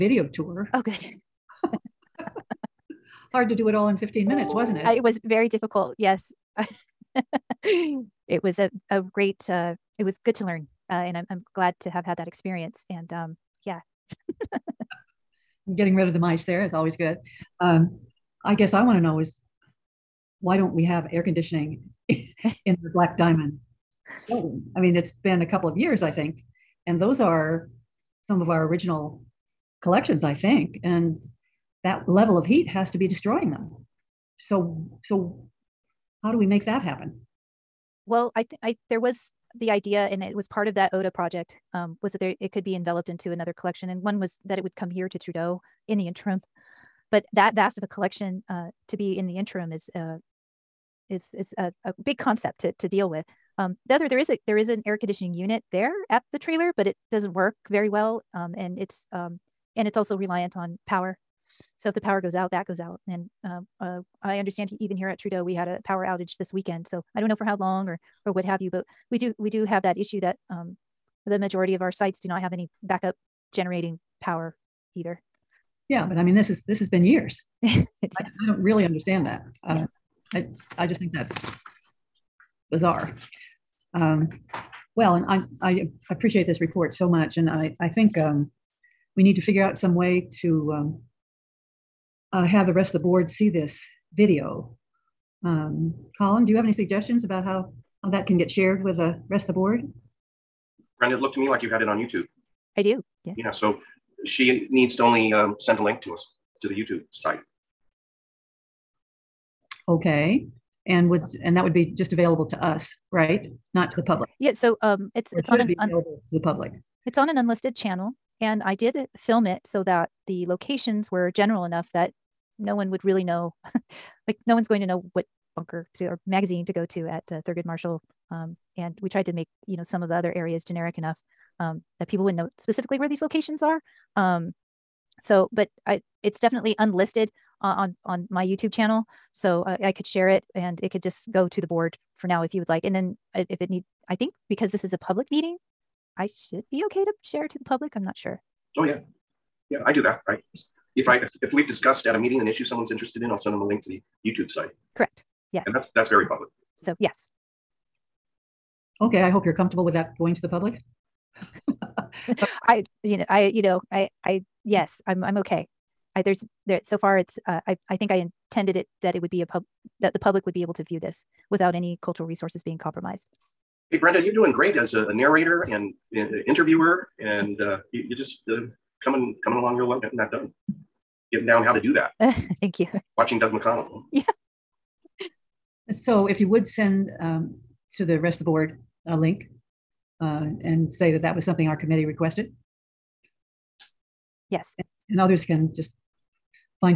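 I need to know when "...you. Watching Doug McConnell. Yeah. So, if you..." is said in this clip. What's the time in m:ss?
3:02.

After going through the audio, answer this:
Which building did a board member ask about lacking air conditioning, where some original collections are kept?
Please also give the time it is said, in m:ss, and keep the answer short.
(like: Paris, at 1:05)
Black Diamond, at 0:22.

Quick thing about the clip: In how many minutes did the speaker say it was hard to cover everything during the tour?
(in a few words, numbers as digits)
15.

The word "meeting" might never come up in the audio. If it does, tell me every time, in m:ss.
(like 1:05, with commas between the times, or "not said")
2:25, 2:32.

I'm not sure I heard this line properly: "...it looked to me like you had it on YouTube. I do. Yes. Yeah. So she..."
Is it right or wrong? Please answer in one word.
right.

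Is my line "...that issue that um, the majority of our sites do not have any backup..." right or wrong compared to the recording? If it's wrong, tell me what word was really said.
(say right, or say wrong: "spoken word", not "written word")
right.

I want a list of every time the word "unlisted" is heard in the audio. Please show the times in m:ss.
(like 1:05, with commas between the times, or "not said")
1:57, 2:16.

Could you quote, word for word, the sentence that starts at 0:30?
And that level of heat has to be destroying them.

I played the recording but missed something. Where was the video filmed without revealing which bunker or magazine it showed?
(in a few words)
Thurgood Marshall.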